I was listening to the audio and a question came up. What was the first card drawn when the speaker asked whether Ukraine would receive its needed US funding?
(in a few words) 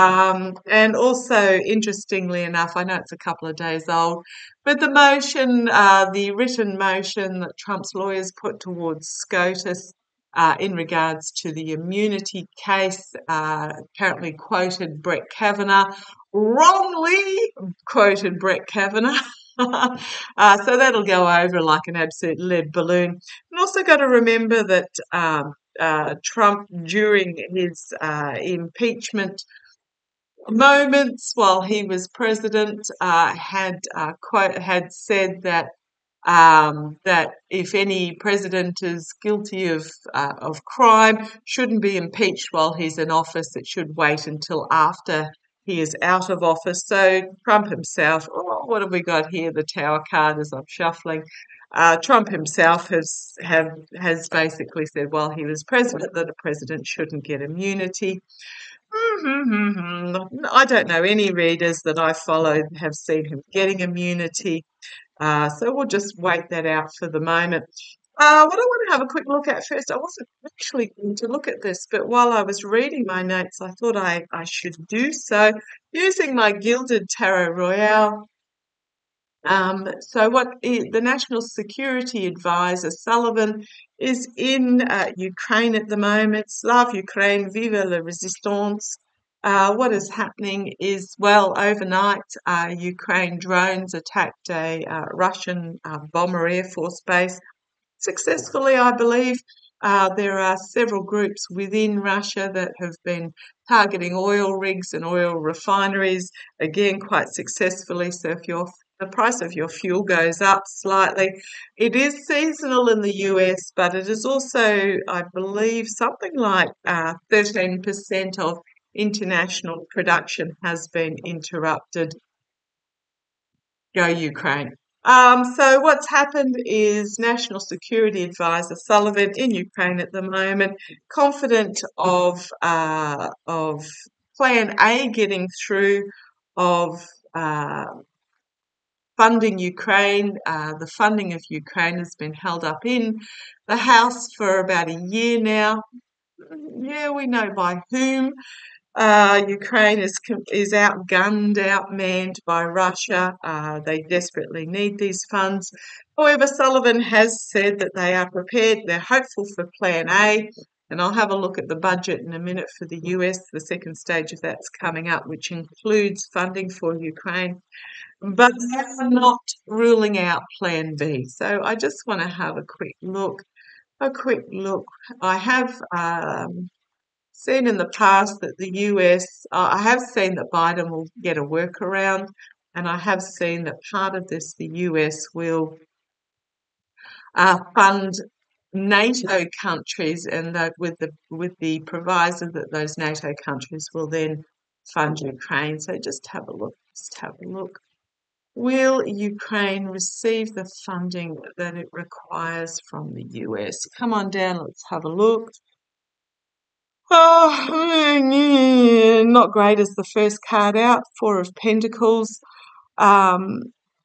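Four of Pentacles.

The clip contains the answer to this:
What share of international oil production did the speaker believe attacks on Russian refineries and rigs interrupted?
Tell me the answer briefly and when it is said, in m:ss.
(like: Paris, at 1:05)
13%, at 1:57.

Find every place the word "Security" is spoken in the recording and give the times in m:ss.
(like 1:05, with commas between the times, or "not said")
1:21, 2:07.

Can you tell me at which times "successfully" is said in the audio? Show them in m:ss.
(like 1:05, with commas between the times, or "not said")
1:38, 1:47.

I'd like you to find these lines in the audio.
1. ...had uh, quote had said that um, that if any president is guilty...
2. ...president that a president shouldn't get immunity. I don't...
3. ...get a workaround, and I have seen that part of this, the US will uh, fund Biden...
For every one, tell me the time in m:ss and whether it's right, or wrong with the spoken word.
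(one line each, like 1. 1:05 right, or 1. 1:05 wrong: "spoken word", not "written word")
1. 0:33 right
2. 0:55 right
3. 3:01 wrong: "NATO", not "Biden".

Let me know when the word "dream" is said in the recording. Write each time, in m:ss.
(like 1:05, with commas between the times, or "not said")
not said.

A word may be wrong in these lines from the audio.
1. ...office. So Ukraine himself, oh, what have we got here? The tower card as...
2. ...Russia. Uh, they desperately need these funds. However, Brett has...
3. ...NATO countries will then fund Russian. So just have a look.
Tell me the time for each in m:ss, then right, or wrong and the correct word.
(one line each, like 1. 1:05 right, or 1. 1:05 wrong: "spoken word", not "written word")
1. 0:46 wrong: "Trump", not "Ukraine"
2. 2:32 wrong: "Sullivan", not "Brett"
3. 3:12 wrong: "Ukraine", not "Russian".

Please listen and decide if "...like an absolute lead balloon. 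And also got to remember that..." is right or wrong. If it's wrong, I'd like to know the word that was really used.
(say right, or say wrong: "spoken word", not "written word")
right.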